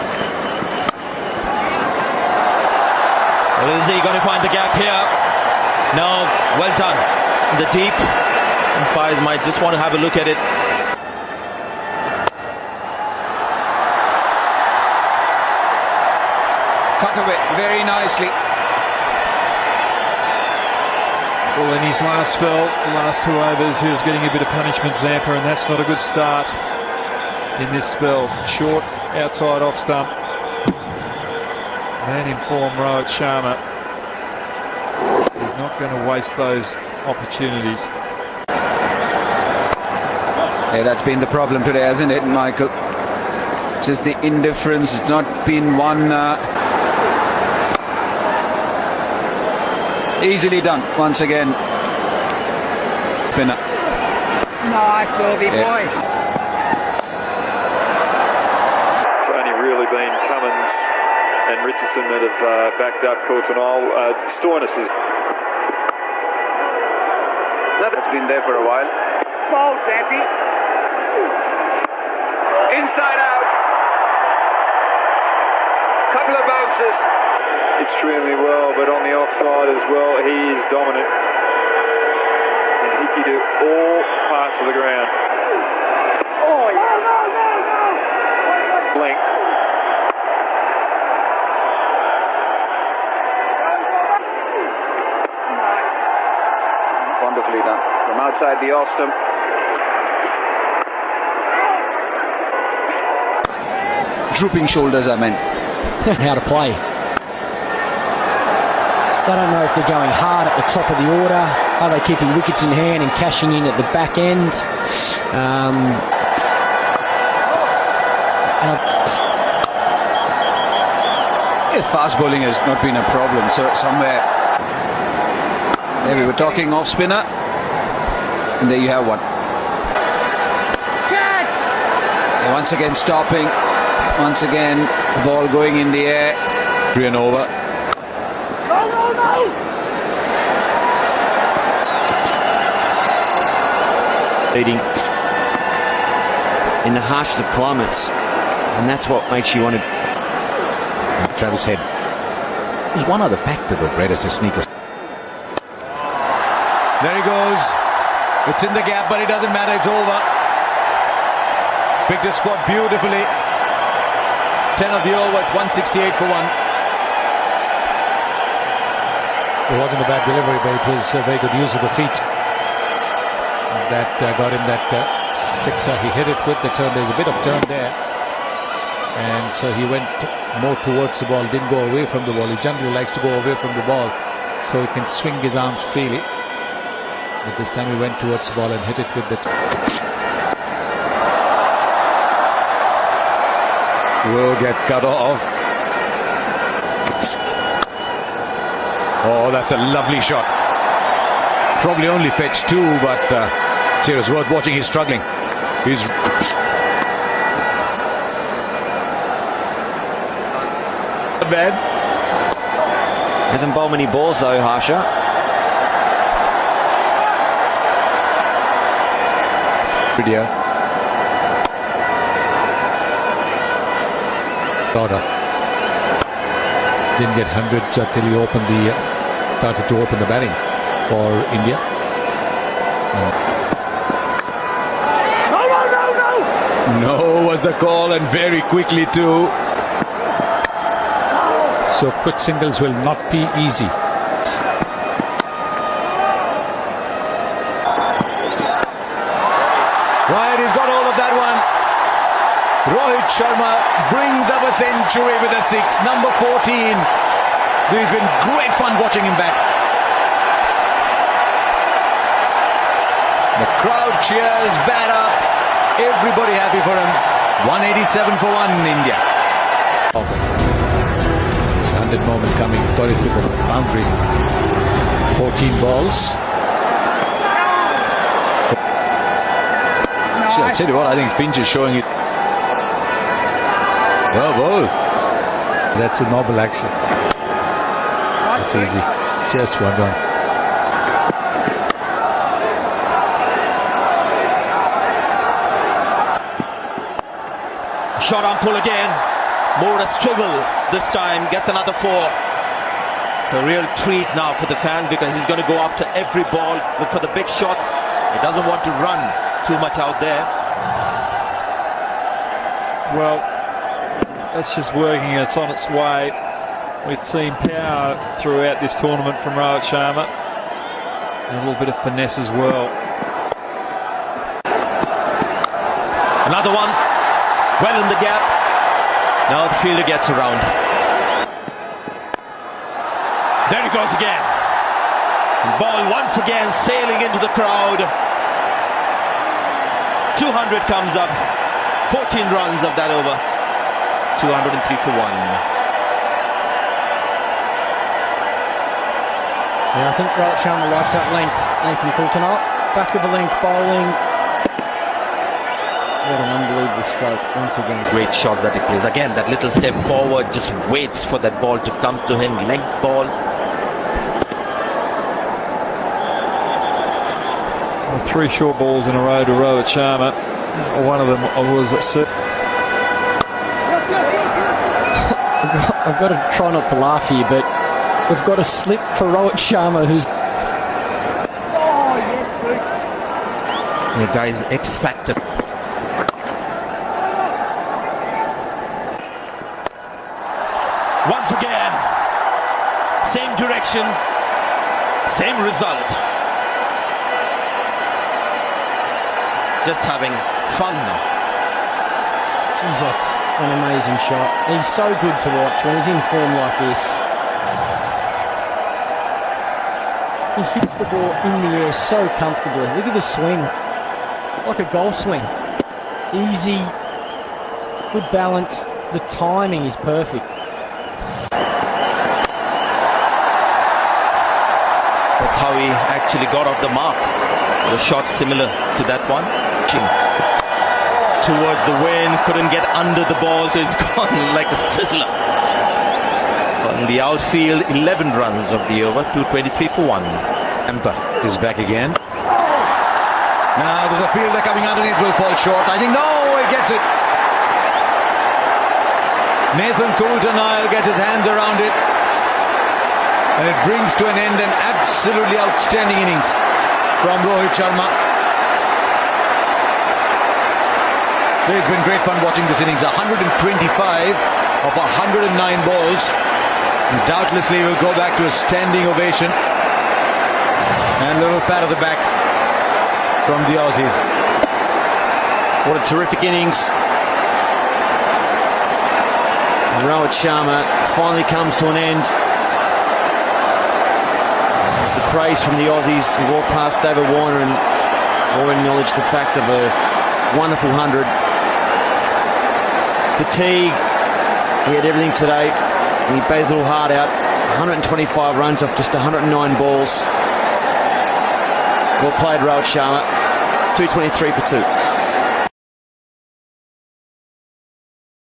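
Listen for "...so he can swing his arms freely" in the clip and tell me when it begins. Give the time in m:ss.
3:04.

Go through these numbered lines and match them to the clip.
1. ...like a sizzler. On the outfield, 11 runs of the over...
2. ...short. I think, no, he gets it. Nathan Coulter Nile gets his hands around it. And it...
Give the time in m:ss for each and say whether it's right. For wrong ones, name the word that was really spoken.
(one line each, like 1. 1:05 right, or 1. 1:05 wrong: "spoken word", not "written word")
1. 7:14 right
2. 7:25 right.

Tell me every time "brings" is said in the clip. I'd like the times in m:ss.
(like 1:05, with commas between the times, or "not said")
4:14, 7:33.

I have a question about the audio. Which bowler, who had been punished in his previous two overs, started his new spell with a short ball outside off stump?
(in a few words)
Zampa.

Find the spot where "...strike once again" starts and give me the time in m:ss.
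5:57.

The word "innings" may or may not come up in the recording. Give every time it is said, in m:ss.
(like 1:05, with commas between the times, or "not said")
7:36, 7:42, 7:56.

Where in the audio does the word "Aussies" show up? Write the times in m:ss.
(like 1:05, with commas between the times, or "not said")
7:53, 8:05.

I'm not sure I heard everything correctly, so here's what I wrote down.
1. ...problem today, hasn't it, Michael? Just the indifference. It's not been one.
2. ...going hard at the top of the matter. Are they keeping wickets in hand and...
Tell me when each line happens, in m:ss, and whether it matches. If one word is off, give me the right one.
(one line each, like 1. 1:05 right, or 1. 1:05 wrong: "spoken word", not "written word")
1. 0:41 right
2. 1:49 wrong: "order", not "matter".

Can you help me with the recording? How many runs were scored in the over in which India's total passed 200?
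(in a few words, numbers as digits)
14.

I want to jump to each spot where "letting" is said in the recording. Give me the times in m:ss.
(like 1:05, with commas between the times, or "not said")
not said.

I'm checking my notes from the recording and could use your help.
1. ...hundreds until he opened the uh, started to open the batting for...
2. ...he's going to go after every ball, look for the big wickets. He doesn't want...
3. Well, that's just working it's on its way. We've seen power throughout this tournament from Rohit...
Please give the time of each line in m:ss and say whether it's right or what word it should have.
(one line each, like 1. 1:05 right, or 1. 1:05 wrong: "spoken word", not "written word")
1. 3:47 right
2. 5:05 wrong: "shots", not "wickets"
3. 5:13 right.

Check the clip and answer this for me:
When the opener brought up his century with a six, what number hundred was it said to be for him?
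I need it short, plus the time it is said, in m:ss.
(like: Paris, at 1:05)
14, at 4:16.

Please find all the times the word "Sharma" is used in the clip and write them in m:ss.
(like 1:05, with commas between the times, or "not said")
0:33, 4:13, 5:19, 6:09, 6:19, 7:37, 8:00, 8:22.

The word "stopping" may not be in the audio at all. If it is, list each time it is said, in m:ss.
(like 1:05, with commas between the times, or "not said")
2:12.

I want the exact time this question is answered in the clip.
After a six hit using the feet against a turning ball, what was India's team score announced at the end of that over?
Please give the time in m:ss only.
2:45.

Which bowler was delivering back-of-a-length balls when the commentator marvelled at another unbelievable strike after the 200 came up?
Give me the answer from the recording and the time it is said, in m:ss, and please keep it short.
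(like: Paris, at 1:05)
Nathan Coulter-Nile, at 5:51.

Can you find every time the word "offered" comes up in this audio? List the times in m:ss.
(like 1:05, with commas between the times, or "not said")
not said.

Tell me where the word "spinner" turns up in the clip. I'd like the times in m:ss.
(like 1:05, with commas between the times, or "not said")
0:53, 2:06.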